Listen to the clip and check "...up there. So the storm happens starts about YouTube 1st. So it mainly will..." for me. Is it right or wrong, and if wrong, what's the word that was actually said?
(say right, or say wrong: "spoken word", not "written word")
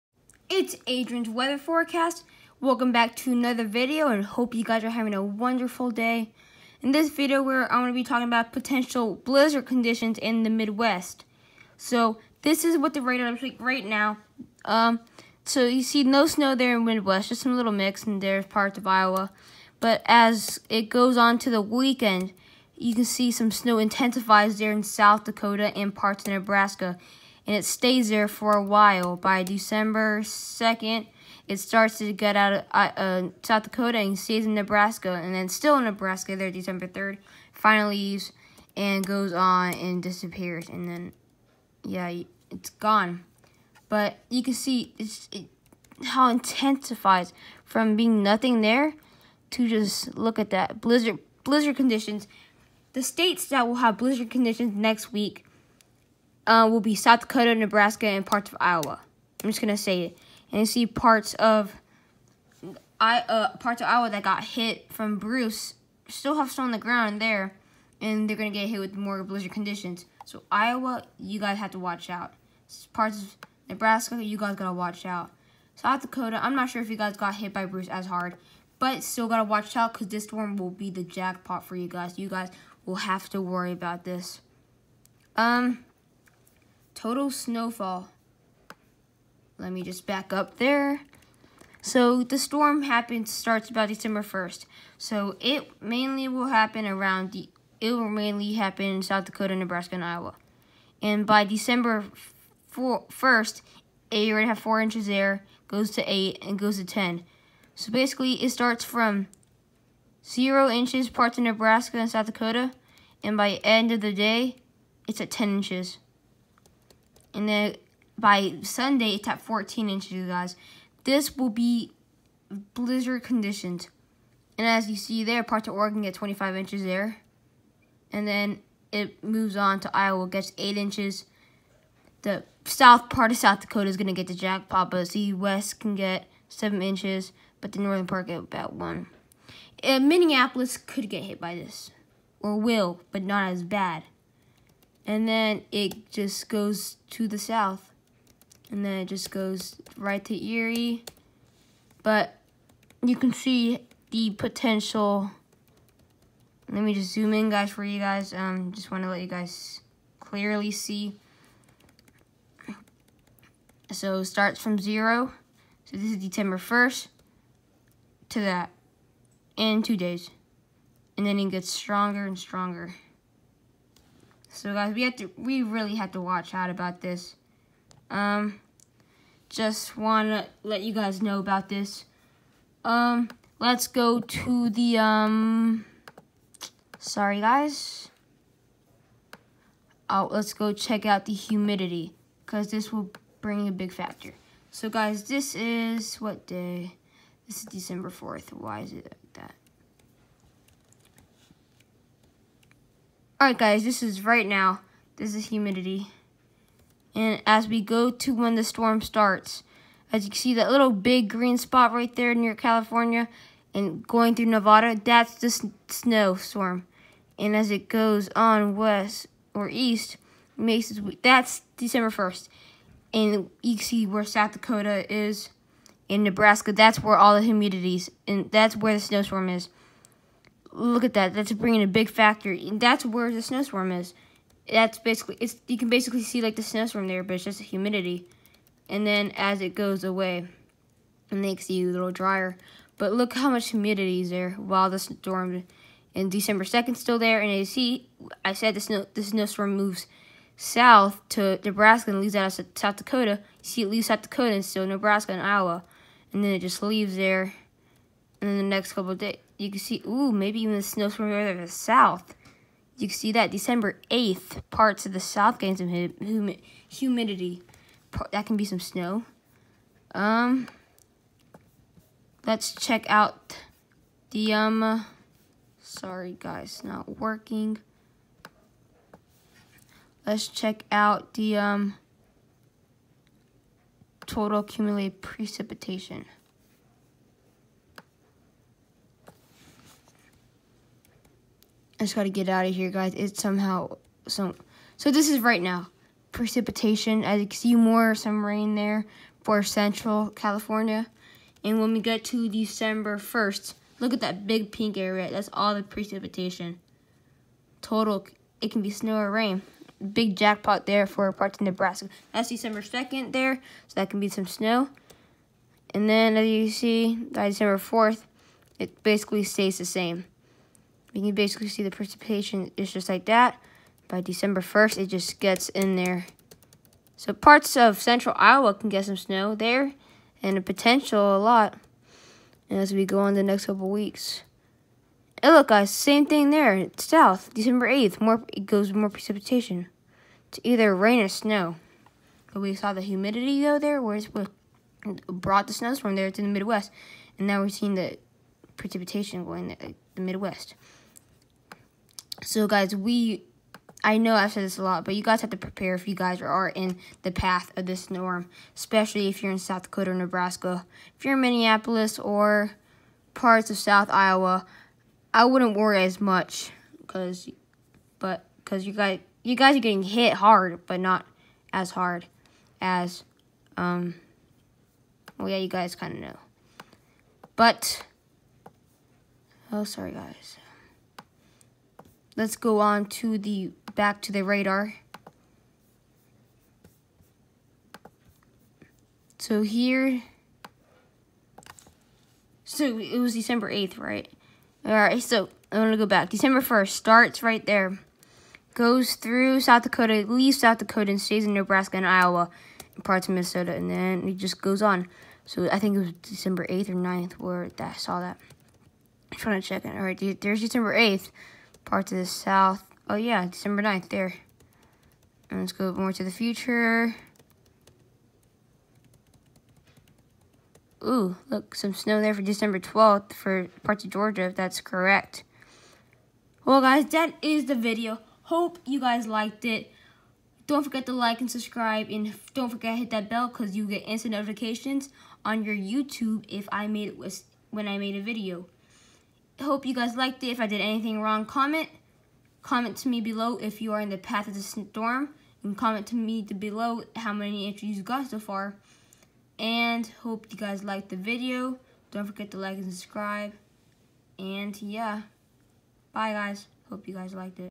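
wrong: "December", not "YouTube".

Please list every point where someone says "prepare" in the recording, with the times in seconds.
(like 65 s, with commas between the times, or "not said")
355 s.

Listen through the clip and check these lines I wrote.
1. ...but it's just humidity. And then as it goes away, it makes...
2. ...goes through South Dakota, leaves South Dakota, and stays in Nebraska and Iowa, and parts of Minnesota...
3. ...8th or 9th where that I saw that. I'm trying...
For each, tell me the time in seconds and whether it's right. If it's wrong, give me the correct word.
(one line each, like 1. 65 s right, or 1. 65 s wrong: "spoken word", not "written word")
1. 237 s right
2. 398 s right
3. 406 s right.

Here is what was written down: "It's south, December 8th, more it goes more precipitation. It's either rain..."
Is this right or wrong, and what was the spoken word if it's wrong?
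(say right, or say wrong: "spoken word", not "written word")
right.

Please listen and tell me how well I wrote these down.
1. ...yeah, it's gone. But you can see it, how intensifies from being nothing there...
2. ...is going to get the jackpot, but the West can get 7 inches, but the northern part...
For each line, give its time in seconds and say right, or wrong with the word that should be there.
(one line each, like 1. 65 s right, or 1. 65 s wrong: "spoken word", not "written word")
1. 41 s right
2. 133 s right.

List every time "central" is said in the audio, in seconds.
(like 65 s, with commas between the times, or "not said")
299 s, 328 s.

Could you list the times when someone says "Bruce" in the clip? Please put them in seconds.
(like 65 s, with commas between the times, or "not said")
65 s, 77 s.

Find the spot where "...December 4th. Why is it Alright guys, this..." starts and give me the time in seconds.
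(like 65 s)
197 s.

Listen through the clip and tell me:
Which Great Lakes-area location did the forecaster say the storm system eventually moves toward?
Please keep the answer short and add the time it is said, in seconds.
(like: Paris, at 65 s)
Erie, at 150 s.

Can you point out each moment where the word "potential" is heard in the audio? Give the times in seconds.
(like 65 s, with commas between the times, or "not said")
8 s, 154 s, 330 s.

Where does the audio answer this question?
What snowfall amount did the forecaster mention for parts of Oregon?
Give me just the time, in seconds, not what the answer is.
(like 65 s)
126 s.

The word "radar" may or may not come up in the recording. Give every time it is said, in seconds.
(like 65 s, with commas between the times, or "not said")
13 s, 384 s.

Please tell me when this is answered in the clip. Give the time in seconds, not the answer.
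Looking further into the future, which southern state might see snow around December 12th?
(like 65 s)
424 s.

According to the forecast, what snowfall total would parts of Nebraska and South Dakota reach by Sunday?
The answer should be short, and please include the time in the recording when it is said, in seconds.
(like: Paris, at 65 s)
14 inches, at 119 s.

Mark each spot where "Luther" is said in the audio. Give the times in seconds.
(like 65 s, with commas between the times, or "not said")
not said.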